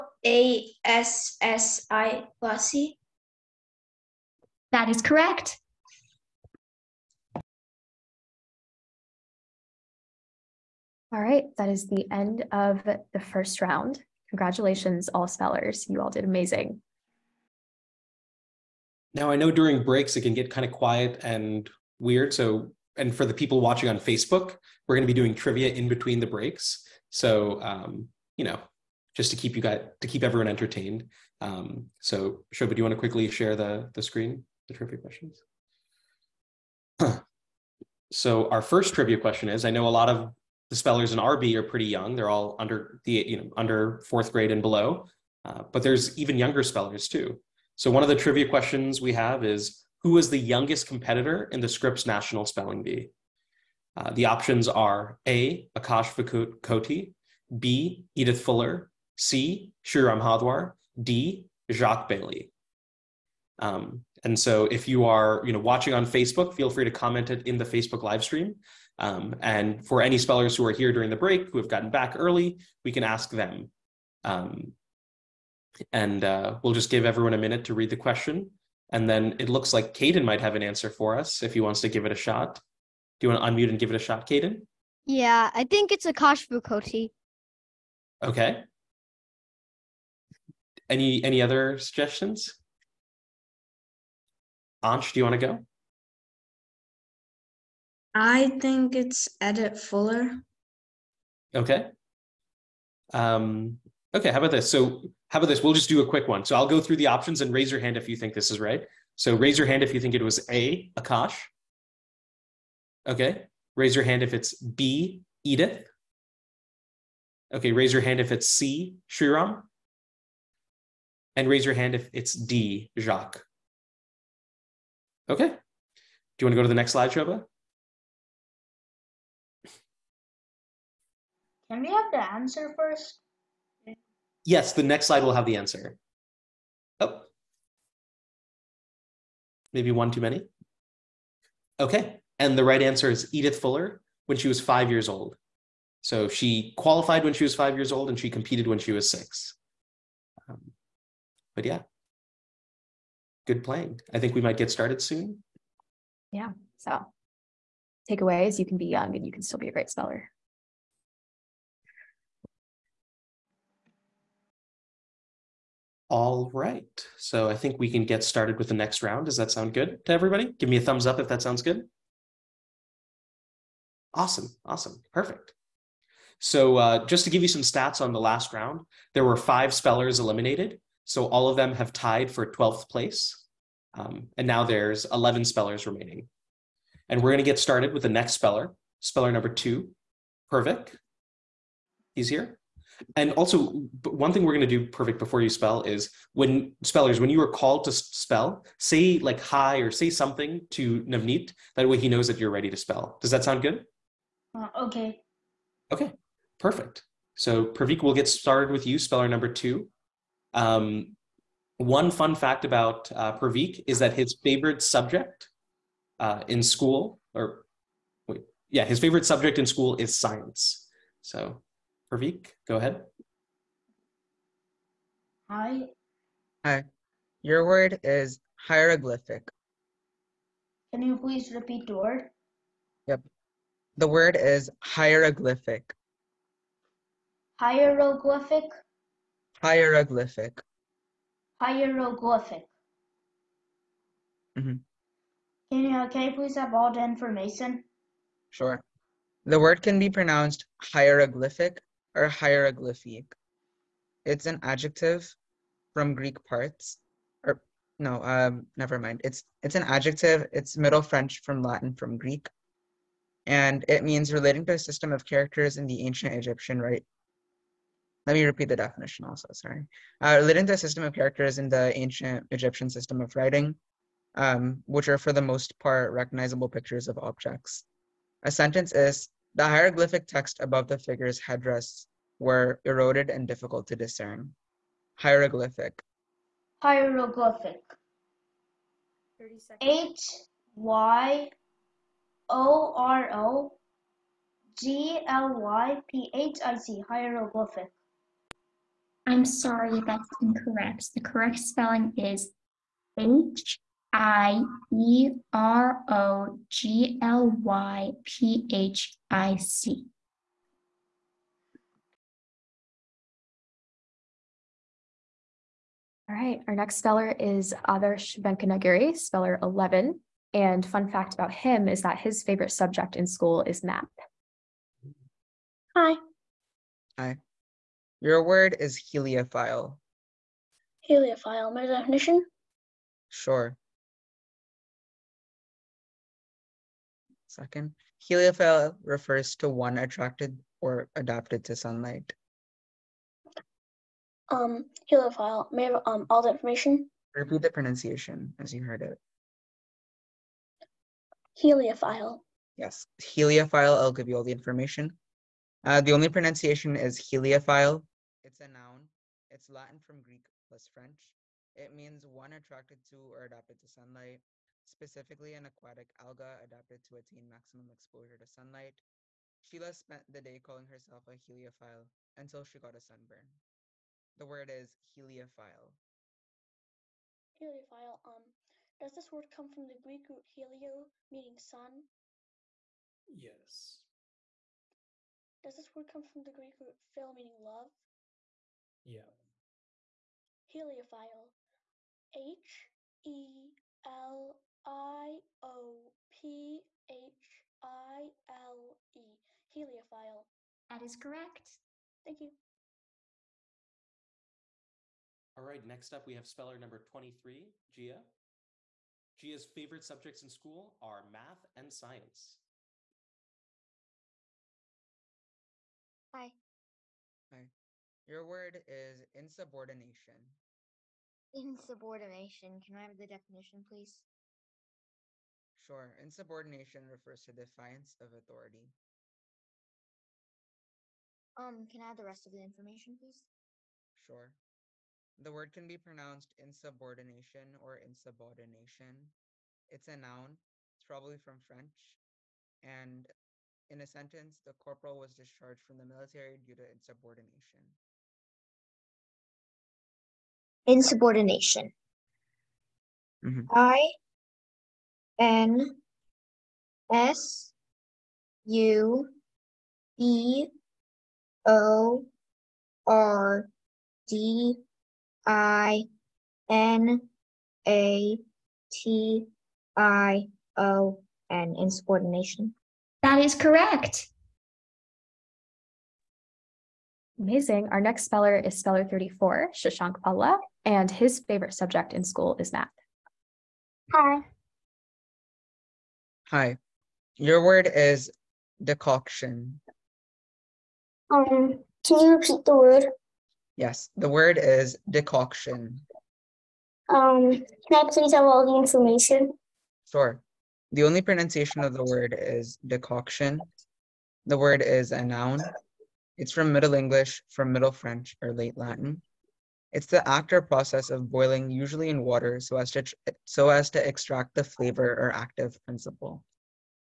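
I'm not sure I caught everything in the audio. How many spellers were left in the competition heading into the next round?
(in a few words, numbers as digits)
11.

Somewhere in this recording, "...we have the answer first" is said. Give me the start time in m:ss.
2:11.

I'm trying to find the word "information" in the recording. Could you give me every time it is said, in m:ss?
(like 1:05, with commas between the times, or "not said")
4:07, 5:46, 5:54, 7:12, 8:18.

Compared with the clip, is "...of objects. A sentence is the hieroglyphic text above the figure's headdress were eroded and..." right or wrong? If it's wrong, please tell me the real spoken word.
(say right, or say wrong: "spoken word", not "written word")
right.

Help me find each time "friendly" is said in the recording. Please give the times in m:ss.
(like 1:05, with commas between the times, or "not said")
not said.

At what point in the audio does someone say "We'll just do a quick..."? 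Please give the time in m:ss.
1:45.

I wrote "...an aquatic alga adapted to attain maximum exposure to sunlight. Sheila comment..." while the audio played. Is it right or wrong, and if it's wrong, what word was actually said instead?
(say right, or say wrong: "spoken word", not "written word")
wrong: "spent", not "comment".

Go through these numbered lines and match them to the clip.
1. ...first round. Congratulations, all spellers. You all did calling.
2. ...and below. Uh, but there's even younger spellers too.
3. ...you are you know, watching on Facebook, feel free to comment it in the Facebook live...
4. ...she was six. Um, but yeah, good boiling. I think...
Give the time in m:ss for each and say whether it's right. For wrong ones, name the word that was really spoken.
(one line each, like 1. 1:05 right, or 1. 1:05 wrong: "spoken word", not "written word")
1. 0:13 wrong: "amazing", not "calling"
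2. 0:44 right
3. 1:04 right
4. 2:28 wrong: "playing", not "boiling".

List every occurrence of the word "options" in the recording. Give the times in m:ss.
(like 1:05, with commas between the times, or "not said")
0:54, 1:47.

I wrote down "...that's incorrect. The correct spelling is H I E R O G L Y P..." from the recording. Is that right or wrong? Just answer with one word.
right.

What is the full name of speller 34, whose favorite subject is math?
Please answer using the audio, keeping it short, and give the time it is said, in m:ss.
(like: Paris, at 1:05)
Shashank Palla, at 7:59.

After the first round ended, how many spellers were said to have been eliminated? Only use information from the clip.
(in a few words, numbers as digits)
5.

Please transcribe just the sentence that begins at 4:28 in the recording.
Let me repeat the definition also.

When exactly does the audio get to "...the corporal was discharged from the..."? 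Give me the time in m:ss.
7:24.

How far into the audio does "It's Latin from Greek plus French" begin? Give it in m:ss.
5:59.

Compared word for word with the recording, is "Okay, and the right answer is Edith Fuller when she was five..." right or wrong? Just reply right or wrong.
right.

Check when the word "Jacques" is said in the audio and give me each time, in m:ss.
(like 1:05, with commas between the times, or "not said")
1:01, 2:02.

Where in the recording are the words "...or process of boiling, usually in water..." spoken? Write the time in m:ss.
8:30.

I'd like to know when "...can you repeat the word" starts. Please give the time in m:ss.
8:12.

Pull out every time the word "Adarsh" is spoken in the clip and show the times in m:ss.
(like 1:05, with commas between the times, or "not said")
5:17.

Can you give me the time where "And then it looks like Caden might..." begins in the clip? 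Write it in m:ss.
1:18.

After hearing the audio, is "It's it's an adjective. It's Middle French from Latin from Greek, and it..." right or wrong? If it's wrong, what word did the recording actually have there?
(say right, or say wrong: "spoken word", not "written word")
right.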